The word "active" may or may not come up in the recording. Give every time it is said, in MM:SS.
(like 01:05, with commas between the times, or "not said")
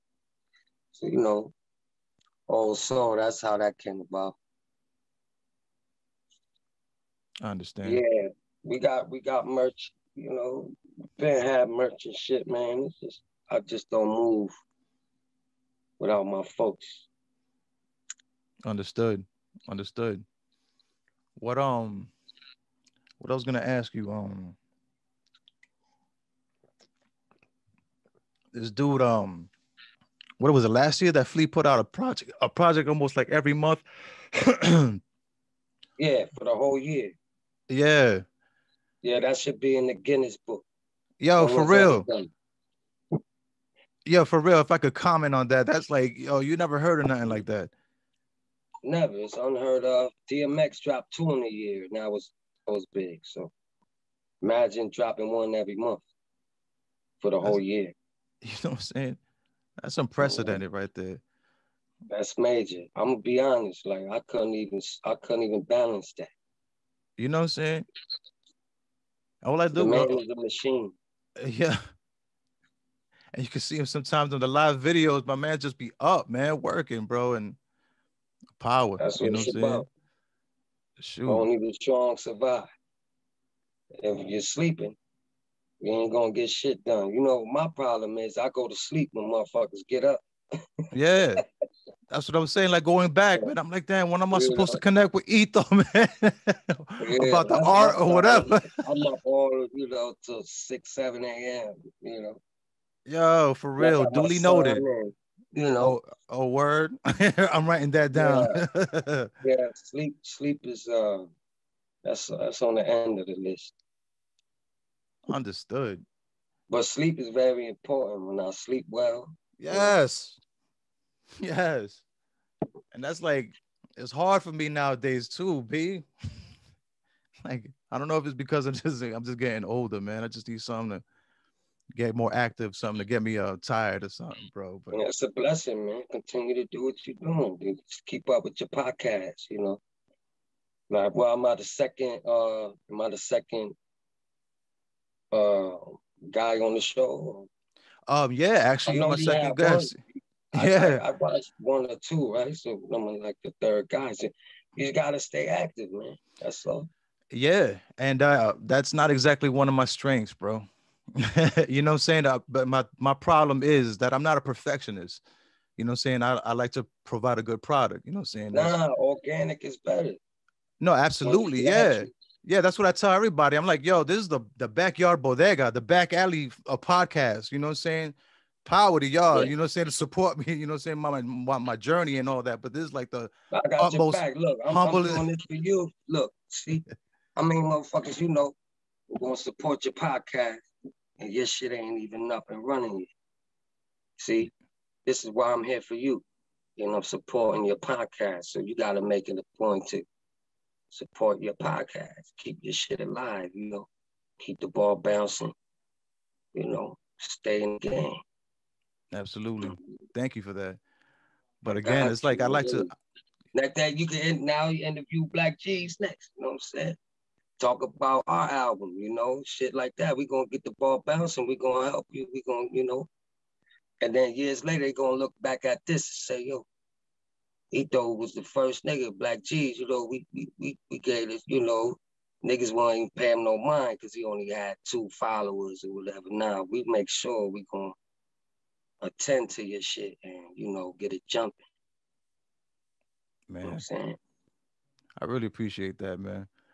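02:12, 02:35.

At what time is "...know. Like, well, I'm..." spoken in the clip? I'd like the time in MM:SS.
02:19.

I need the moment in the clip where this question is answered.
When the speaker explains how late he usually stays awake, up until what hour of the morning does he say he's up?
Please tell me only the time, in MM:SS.
01:40.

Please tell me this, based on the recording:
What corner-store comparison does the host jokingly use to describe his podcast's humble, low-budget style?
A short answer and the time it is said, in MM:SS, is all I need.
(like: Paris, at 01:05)
the backyard bodega, at 02:54.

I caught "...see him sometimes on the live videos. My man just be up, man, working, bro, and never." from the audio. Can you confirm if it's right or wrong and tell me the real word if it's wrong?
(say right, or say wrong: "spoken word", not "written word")
wrong: "power", not "never".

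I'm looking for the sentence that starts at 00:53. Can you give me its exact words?
So imagine dropping one every month for the that's, whole year.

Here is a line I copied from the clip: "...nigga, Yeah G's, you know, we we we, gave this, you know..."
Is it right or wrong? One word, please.
wrong.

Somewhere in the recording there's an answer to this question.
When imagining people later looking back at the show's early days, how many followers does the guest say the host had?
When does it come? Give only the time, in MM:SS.
03:54.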